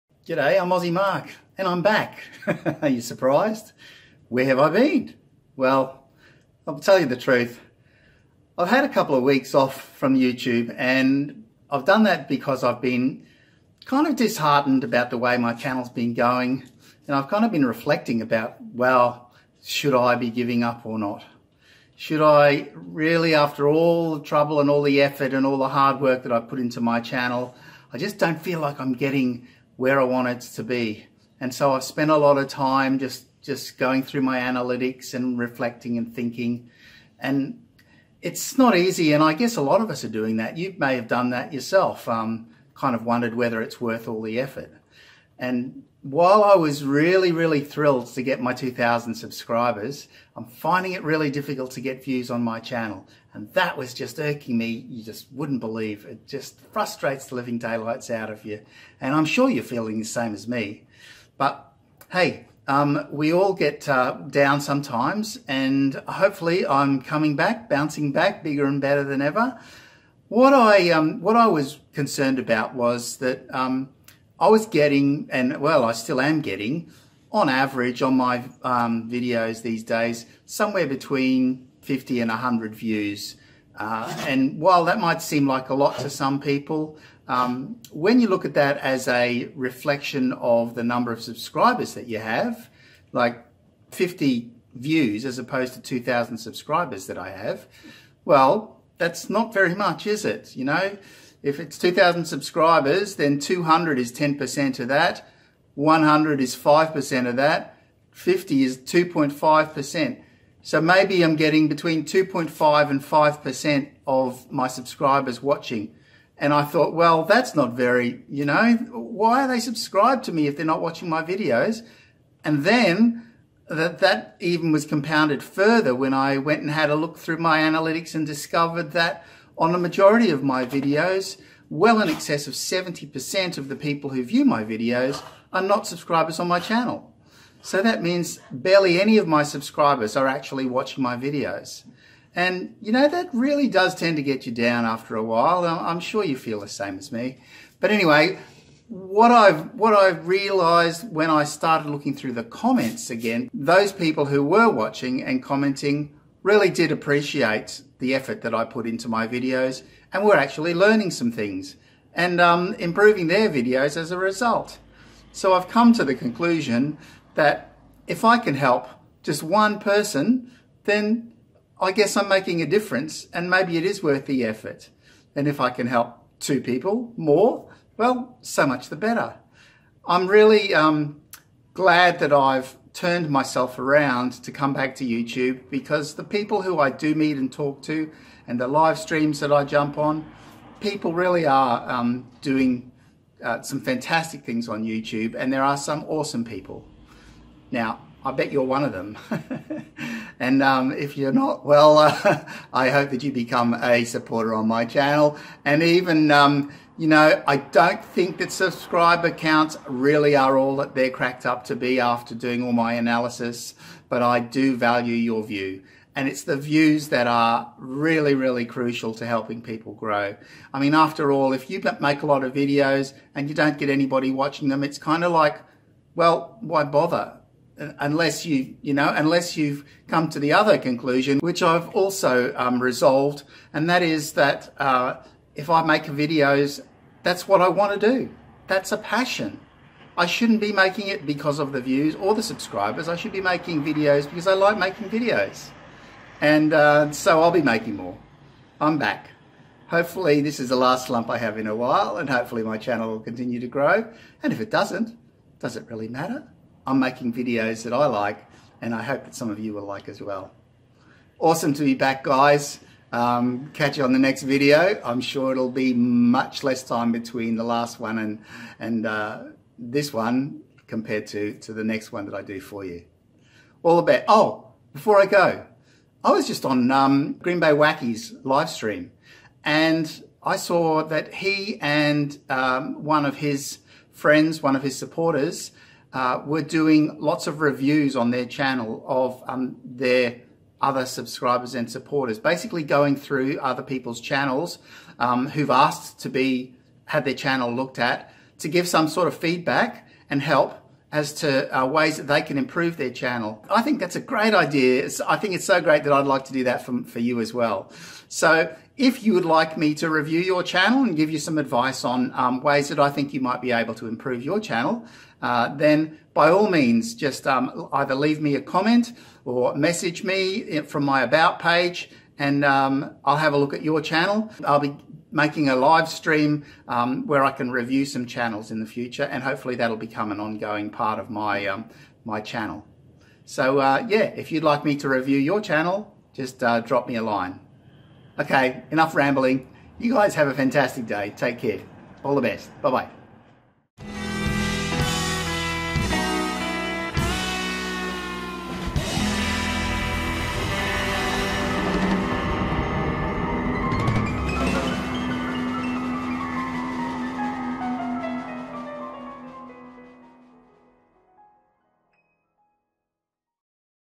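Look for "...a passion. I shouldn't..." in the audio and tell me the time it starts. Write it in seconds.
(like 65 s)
238 s.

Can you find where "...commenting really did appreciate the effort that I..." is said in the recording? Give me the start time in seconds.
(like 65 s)
155 s.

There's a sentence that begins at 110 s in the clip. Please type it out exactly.
So maybe I'm getting between 2.5 and 5% of my subscribers watching.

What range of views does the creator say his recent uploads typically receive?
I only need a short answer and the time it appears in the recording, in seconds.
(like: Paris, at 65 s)
50 to 100, at 80 s.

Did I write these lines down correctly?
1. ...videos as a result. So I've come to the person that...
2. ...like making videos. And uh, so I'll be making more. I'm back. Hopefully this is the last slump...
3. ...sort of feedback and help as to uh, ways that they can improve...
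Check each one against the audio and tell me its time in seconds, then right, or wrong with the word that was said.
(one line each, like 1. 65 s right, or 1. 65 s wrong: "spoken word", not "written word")
1. 163 s wrong: "conclusion", not "person"
2. 244 s right
3. 299 s right.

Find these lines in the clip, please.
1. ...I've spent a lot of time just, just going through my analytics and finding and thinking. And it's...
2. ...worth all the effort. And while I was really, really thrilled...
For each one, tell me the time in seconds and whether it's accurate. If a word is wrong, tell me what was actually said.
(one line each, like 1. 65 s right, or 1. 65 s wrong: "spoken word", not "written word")
1. 31 s wrong: "reflecting", not "finding"
2. 43 s right.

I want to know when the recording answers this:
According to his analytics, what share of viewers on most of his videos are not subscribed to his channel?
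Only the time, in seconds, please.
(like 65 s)
132 s.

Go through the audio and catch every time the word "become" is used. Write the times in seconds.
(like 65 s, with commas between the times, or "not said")
203 s, 329 s.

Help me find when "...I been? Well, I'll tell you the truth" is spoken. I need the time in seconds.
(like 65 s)
4 s.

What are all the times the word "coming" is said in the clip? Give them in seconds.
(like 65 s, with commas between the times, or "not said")
67 s.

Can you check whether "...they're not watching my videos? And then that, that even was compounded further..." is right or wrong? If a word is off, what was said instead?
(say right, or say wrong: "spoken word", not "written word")
right.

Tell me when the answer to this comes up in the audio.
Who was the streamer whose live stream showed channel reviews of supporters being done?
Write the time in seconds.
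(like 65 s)
277 s.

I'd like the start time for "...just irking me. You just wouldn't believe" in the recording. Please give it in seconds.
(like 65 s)
53 s.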